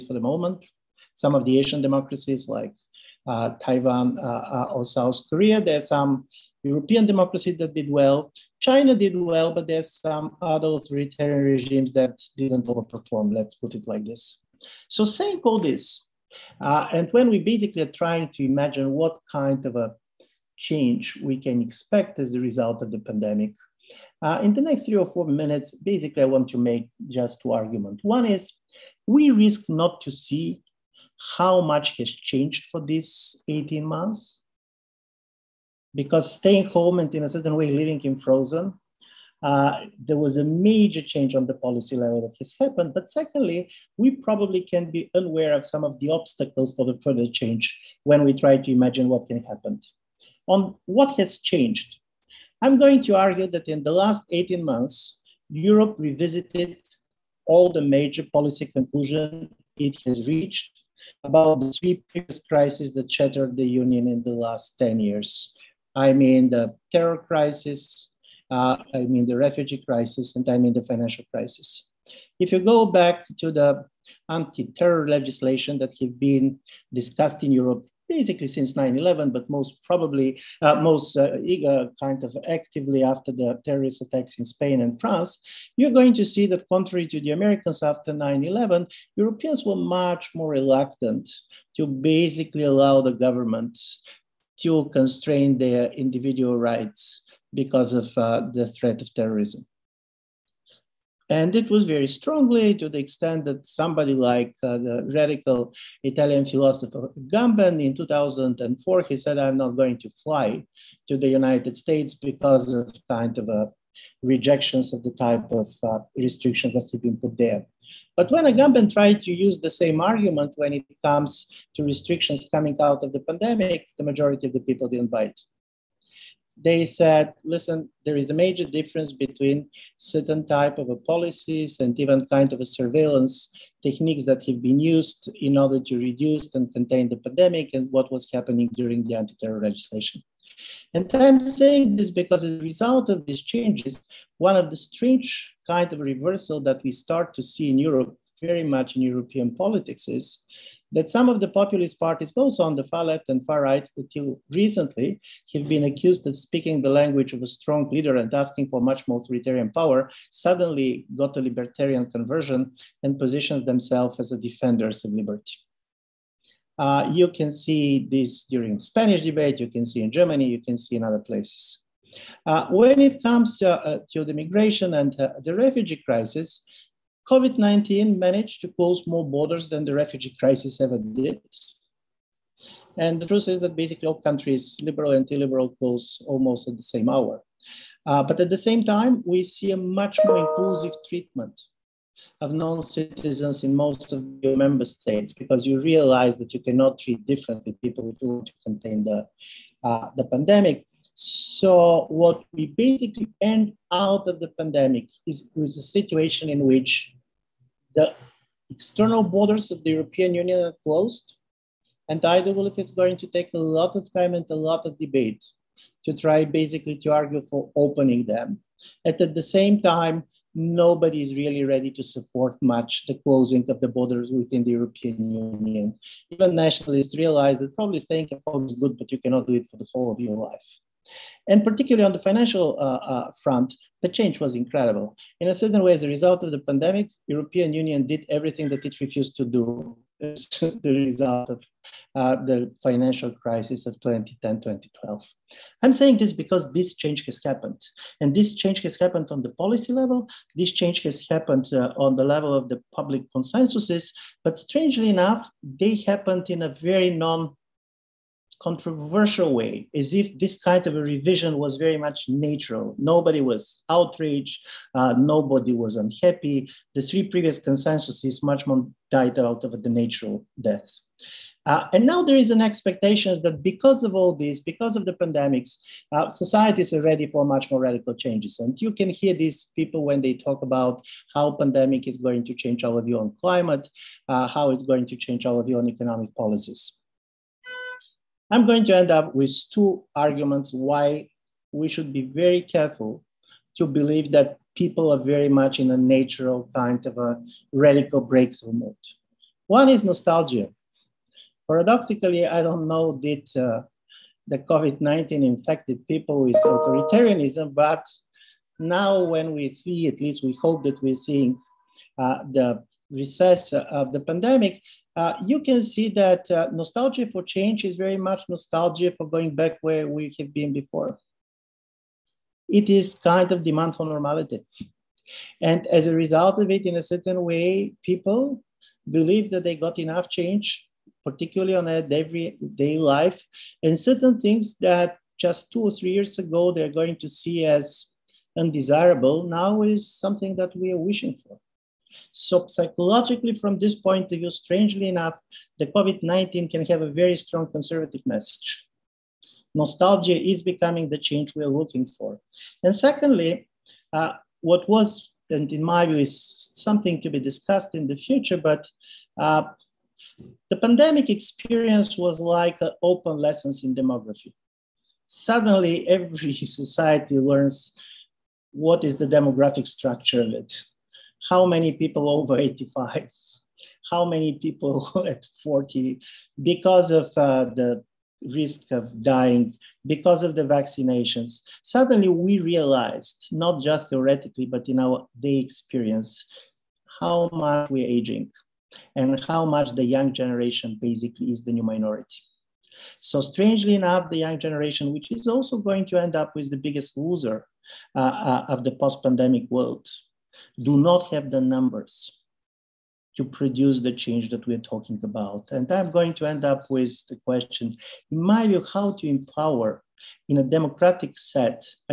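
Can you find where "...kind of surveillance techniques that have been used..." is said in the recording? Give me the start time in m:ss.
2:12.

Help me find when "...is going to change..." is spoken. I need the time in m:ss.
4:42.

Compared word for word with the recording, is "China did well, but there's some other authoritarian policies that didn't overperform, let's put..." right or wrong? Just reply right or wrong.
wrong.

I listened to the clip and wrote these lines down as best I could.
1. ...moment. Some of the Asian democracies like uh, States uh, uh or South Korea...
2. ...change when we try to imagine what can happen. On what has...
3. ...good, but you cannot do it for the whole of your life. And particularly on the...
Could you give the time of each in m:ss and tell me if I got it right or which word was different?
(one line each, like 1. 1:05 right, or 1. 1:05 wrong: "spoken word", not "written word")
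1. 0:00 wrong: "Taiwan", not "States"
2. 0:47 right
3. 3:48 right.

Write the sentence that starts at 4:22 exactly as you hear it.
Nobody was outraged, uh, nobody was unhappy.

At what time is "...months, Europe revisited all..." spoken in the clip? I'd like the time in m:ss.
0:54.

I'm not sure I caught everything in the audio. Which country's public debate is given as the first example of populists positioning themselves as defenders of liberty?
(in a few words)
Spain.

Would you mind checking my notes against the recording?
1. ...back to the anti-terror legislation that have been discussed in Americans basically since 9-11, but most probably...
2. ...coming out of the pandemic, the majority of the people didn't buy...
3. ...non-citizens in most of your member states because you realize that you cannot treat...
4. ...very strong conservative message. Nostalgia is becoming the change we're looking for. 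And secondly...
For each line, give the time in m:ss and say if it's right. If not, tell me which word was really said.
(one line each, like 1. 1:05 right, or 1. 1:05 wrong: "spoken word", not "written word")
1. 1:12 wrong: "Europe", not "Americans"
2. 2:02 right
3. 3:12 right
4. 5:47 right.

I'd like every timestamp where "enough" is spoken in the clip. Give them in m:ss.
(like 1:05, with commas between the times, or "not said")
4:15, 5:29, 5:45, 6:33.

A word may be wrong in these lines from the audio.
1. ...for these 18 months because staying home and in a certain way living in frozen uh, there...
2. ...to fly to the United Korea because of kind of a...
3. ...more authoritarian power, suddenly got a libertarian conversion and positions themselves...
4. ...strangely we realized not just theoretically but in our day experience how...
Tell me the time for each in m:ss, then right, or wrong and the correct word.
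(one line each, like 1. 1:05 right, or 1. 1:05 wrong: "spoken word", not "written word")
1. 0:32 right
2. 1:49 wrong: "States", not "Korea"
3. 2:39 right
4. 6:21 wrong: "suddenly", not "strangely".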